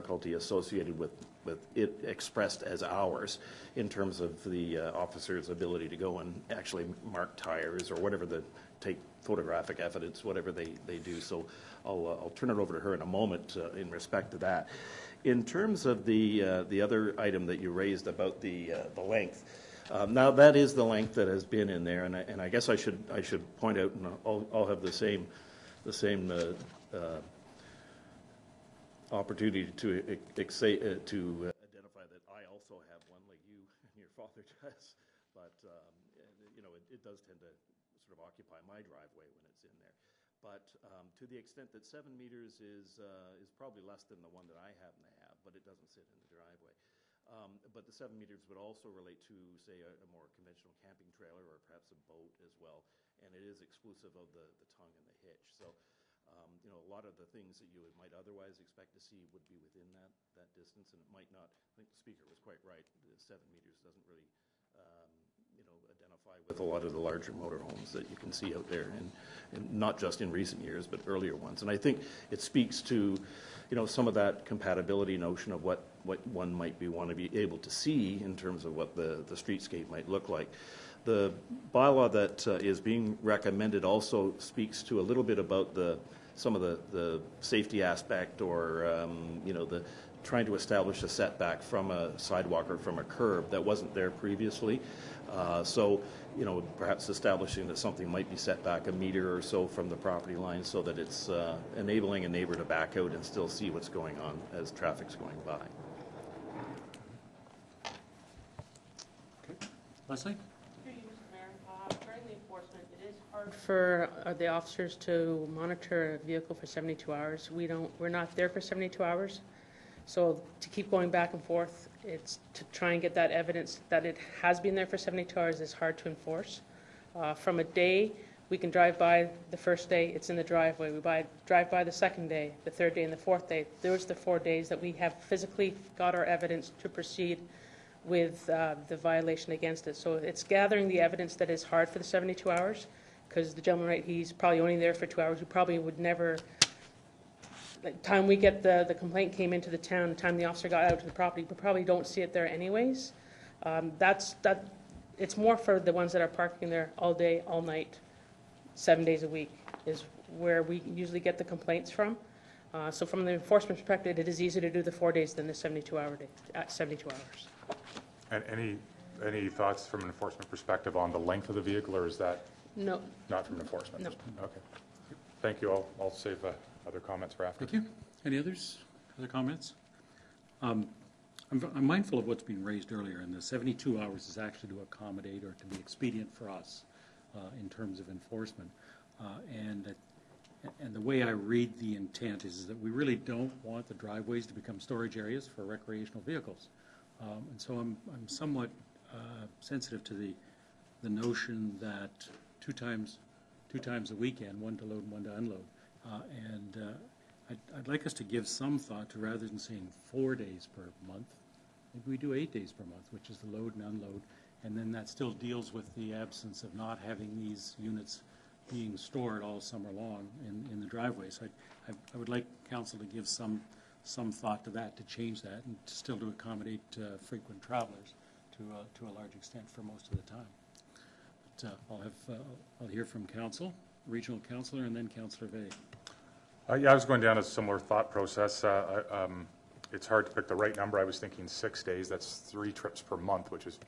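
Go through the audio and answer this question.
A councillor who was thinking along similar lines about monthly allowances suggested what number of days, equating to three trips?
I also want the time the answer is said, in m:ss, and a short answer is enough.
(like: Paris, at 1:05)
6 days, at 4:01.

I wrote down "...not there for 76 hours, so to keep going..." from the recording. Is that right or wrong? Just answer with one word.
wrong.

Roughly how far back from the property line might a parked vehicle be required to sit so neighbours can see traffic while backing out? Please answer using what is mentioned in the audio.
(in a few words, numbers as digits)
a meter.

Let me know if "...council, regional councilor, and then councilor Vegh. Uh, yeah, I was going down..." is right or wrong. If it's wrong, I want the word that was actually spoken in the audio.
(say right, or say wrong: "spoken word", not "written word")
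right.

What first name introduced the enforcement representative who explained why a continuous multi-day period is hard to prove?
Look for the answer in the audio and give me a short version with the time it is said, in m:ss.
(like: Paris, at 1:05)
Leslie, at 1:50.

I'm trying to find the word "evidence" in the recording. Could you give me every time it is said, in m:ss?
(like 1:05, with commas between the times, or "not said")
0:09, 2:03, 2:16, 2:20.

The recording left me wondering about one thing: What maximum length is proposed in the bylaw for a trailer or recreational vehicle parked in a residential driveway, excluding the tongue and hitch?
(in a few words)
7 meters.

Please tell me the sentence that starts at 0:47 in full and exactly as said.
Um, but the seven meters would also relate to, say, a, a, more conventional camping trailer or perhaps a boat as well.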